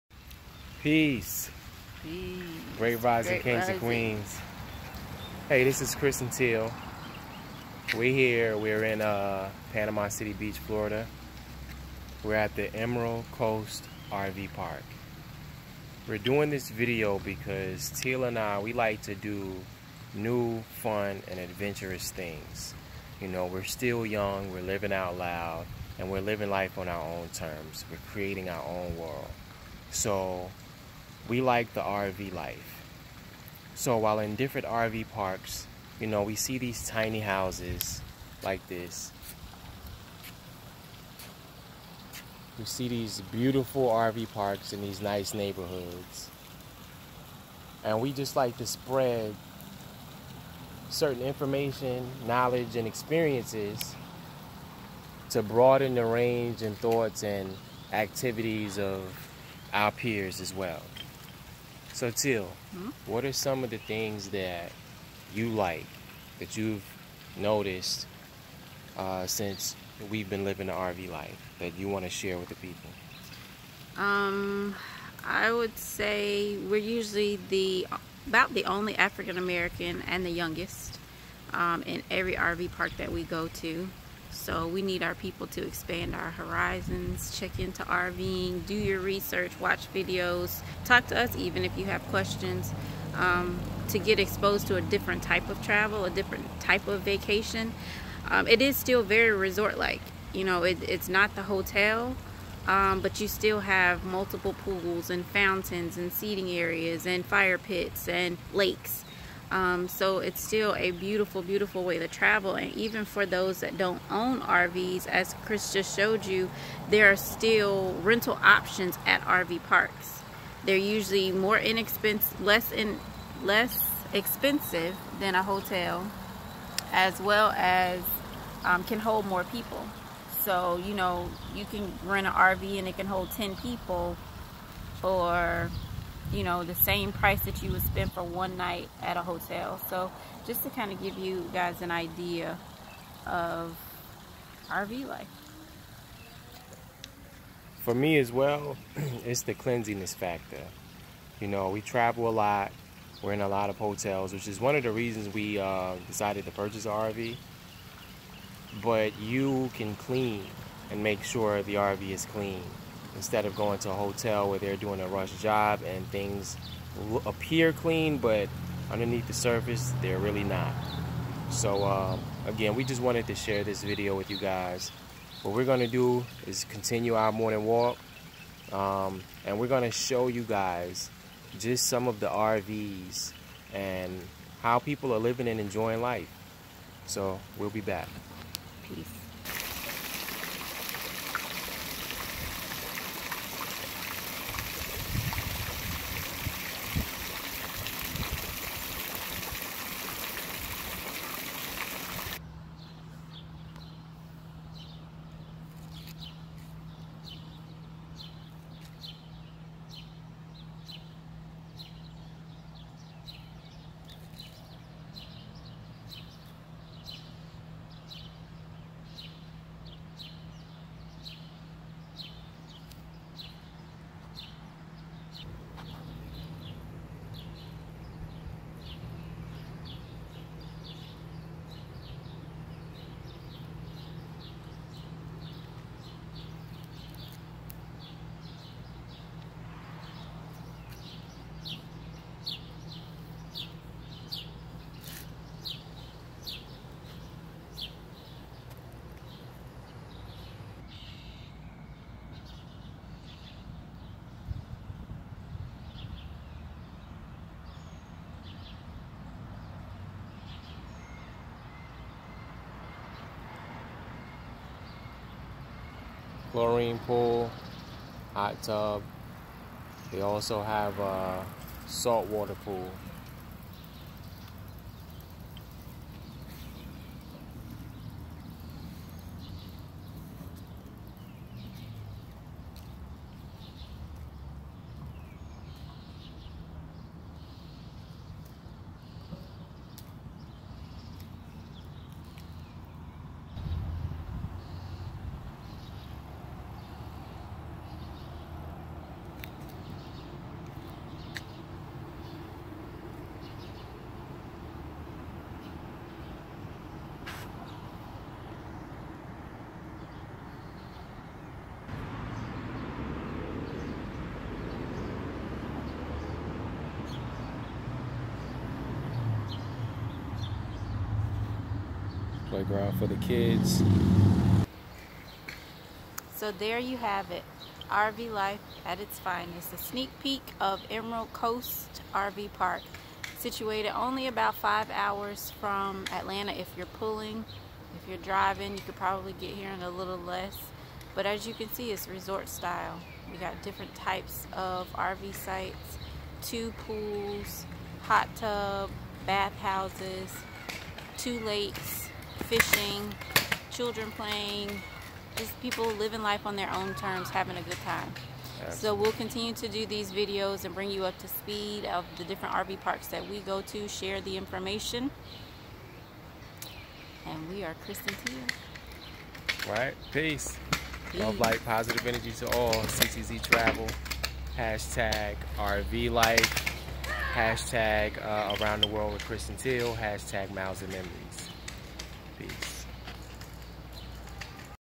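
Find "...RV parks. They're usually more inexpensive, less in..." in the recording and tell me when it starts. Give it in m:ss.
1:59.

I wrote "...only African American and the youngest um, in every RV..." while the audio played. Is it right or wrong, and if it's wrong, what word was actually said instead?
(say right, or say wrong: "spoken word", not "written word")
right.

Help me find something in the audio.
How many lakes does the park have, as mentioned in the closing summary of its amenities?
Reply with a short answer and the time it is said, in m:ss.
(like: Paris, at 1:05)
2, at 5:51.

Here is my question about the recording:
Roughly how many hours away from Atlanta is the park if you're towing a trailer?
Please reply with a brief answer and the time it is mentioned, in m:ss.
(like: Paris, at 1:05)
5, at 5:34.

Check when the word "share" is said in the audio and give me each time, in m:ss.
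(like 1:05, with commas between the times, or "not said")
1:12, 2:53, 6:03.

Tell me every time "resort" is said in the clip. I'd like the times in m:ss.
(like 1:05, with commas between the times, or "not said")
1:39, 5:42.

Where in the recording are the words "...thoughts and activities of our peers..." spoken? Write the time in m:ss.
0:56.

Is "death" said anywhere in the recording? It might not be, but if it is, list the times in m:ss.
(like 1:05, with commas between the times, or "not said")
not said.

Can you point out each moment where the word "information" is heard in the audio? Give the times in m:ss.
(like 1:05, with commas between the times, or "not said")
0:51, 6:04.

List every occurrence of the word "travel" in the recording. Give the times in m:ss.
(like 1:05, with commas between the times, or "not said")
1:35, 1:52, 2:31, 6:13.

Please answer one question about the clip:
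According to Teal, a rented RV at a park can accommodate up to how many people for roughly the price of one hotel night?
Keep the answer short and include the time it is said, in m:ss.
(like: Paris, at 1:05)
10, at 2:13.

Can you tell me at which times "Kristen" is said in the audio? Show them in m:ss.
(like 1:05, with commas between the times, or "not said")
6:07, 6:19.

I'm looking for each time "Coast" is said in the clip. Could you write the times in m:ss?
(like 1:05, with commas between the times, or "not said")
0:13, 5:31.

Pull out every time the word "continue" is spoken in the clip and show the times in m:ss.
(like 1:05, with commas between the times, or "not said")
2:56, 5:59.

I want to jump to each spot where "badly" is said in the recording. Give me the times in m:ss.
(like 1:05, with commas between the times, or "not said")
not said.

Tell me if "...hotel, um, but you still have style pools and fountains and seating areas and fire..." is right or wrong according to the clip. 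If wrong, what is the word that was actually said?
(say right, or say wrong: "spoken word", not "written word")
wrong: "multiple", not "style".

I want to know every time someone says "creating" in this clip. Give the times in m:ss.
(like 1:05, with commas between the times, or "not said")
0:28.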